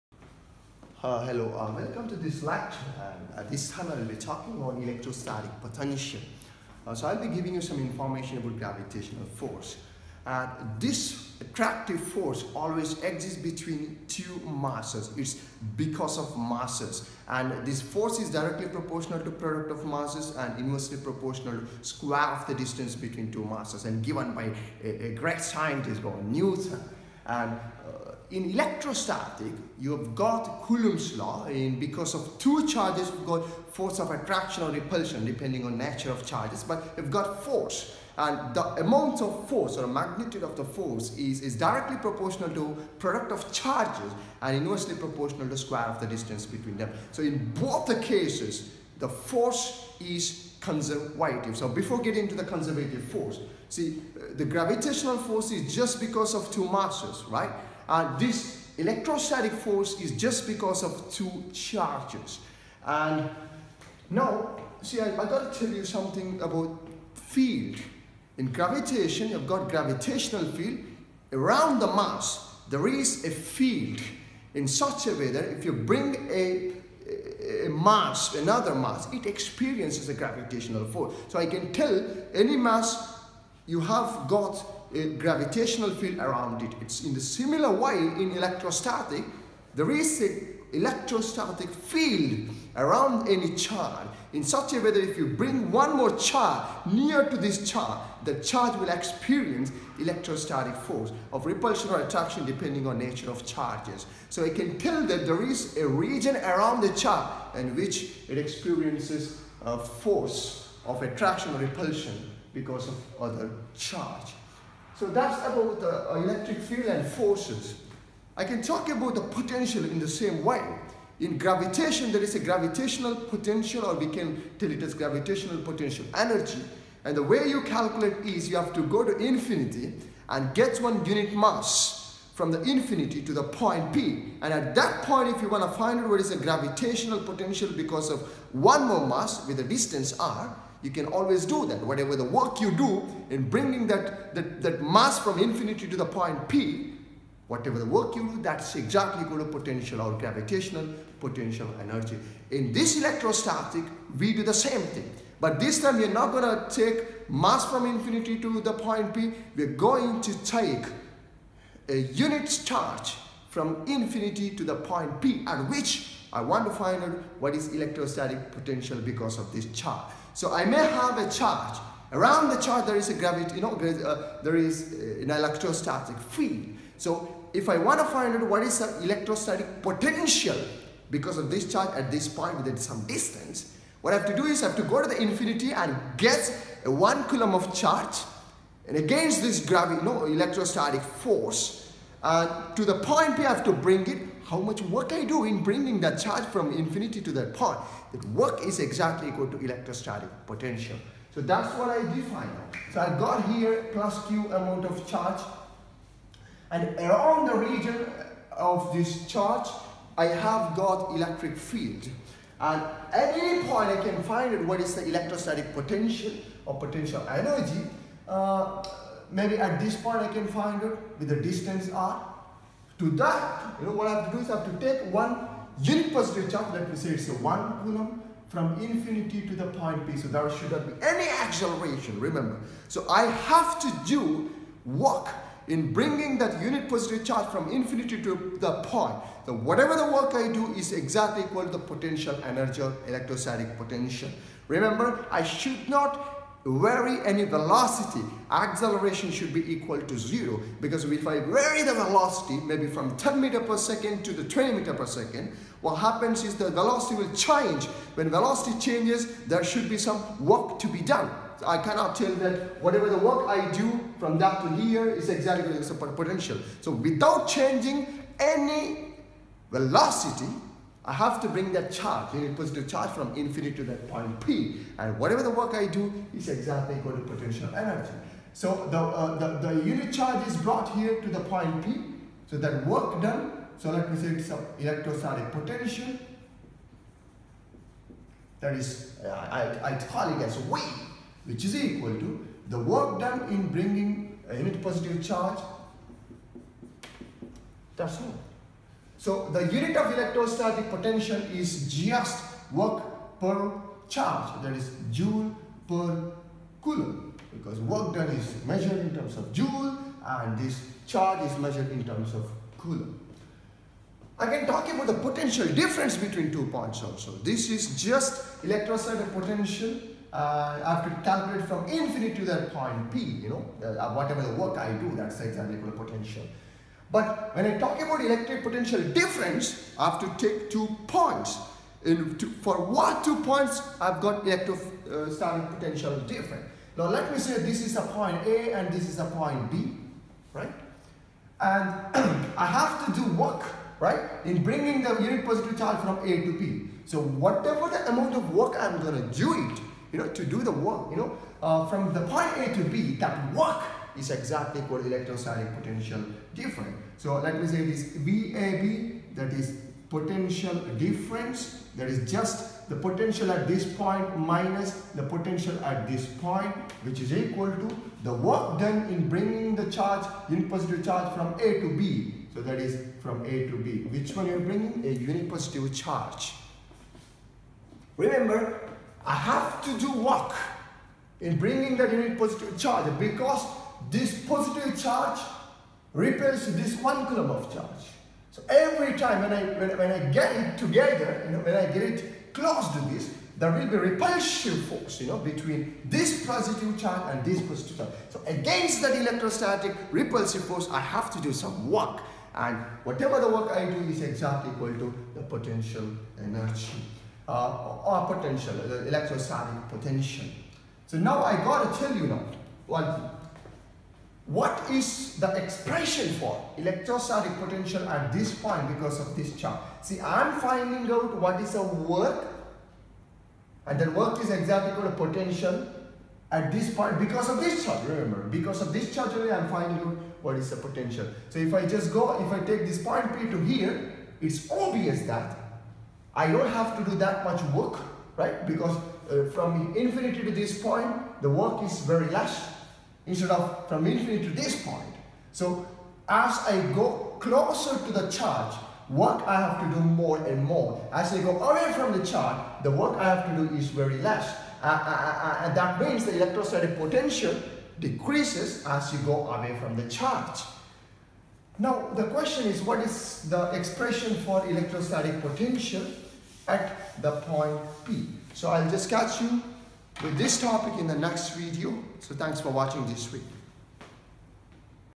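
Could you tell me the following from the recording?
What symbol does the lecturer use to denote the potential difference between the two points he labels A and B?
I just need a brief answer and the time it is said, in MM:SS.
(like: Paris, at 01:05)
VAB, at 05:58.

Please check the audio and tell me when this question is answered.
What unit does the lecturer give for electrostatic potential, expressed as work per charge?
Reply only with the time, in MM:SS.
05:05.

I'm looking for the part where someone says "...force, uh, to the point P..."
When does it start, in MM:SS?
03:11.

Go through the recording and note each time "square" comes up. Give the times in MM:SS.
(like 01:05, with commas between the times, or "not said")
00:21, 00:45.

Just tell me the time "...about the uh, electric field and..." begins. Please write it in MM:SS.
01:55.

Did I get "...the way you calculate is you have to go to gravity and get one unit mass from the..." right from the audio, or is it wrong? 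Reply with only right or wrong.
wrong.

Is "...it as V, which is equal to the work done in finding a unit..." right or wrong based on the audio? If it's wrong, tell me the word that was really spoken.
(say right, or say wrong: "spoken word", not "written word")
wrong: "bringing", not "finding".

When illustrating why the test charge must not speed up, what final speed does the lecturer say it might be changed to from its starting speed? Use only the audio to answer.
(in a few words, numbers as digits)
20 meters per second.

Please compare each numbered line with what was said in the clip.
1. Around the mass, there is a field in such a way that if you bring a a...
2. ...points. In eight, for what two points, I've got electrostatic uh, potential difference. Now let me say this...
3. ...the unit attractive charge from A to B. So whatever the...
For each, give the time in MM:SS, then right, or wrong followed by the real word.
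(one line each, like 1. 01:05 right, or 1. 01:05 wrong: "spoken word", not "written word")
1. 01:11 right
2. 05:31 wrong: "two", not "eight"
3. 05:45 wrong: "positive", not "attractive".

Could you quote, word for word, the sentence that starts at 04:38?
So the, uh, the, the, unit charge is brought here to the point P.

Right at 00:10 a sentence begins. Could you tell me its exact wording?
And this attractive force always exists between two masses.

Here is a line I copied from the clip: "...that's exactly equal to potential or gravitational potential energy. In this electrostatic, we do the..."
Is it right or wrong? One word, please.
right.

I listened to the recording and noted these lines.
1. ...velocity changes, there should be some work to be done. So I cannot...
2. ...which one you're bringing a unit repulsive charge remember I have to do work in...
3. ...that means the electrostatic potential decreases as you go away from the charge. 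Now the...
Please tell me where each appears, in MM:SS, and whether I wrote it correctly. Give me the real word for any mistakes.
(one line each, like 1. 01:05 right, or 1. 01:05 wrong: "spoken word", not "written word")
1. 04:18 right
2. 06:14 wrong: "positive", not "repulsive"
3. 07:35 right.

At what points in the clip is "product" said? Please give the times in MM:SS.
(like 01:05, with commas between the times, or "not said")
00:19, 00:42.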